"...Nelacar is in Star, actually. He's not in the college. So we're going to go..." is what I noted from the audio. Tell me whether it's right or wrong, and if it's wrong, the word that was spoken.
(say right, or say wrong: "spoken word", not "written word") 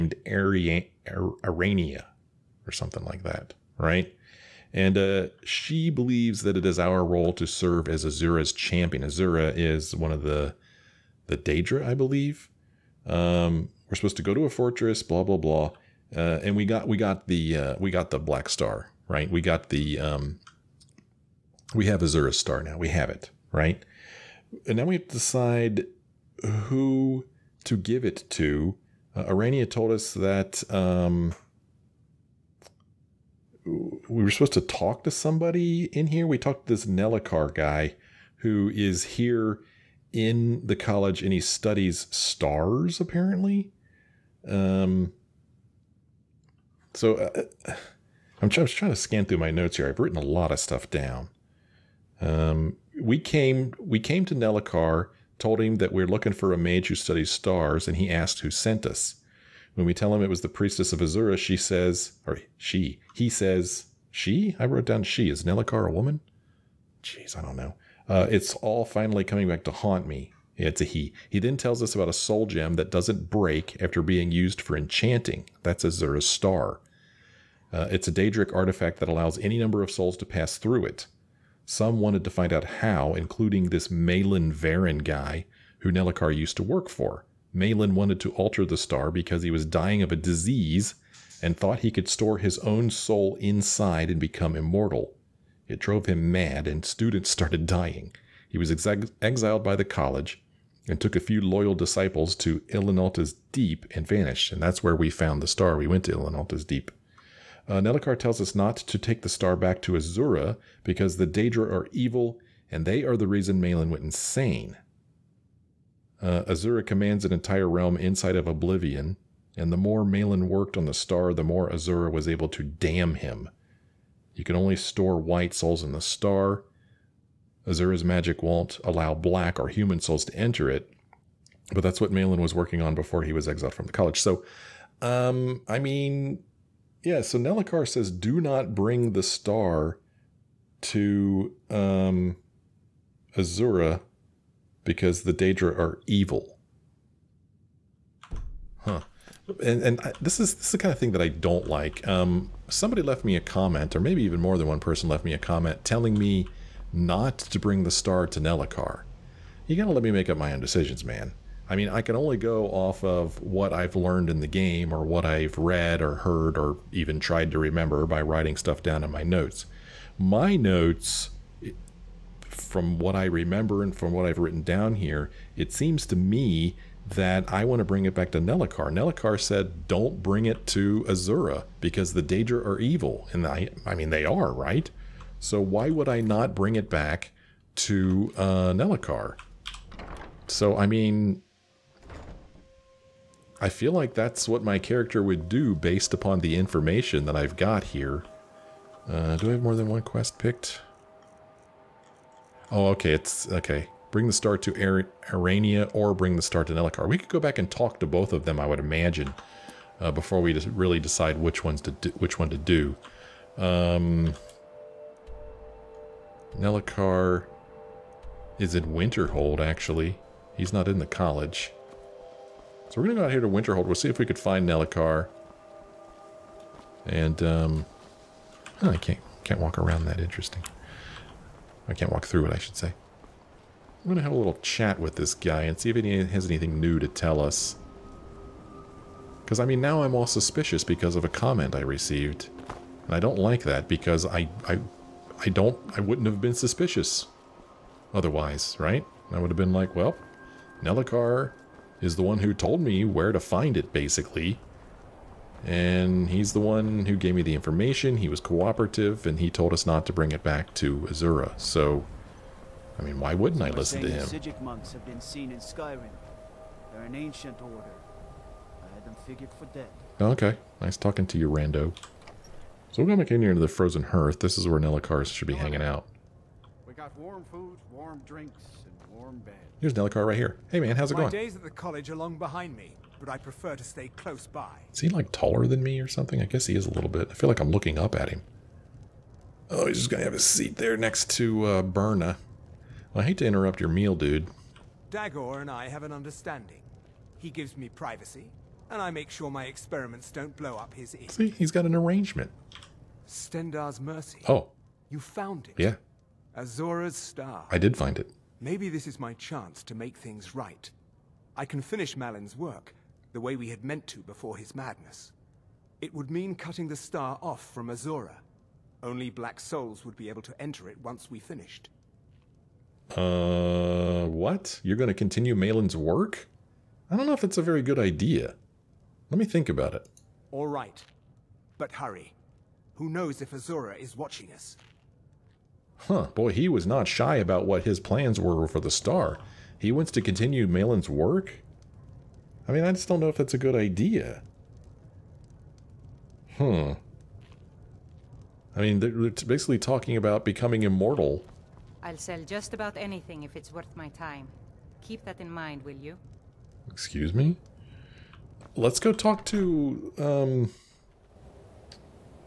wrong: "Winterhold", not "Star".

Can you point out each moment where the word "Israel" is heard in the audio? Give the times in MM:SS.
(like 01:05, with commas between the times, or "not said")
not said.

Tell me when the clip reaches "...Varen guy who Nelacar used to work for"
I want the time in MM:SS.
01:24.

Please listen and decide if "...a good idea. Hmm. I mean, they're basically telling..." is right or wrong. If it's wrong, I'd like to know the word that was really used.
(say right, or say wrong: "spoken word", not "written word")
wrong: "talking", not "telling".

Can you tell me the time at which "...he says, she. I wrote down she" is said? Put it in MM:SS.
01:03.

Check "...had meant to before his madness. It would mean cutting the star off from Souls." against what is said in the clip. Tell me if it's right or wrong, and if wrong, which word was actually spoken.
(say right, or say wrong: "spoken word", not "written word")
wrong: "Azora", not "Souls".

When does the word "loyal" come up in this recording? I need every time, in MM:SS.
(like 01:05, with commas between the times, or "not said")
01:41.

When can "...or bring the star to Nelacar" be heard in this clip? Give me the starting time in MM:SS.
03:25.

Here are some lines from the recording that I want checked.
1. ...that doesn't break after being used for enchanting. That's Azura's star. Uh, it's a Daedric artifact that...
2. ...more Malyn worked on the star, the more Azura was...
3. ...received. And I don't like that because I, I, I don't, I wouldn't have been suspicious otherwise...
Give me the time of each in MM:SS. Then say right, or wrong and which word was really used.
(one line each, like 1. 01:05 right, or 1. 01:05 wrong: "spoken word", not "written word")
1. 01:12 right
2. 01:59 right
3. 04:01 right.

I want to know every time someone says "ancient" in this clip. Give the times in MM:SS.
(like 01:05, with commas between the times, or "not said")
04:27.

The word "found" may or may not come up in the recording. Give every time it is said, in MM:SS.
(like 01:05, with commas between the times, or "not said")
01:45, 05:05.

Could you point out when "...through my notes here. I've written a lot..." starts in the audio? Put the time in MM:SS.
00:49.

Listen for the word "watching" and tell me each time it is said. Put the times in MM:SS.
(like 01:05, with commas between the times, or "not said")
05:34.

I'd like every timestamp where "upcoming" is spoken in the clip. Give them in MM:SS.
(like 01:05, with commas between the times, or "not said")
not said.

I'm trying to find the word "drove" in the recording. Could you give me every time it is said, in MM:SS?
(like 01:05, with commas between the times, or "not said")
01:35.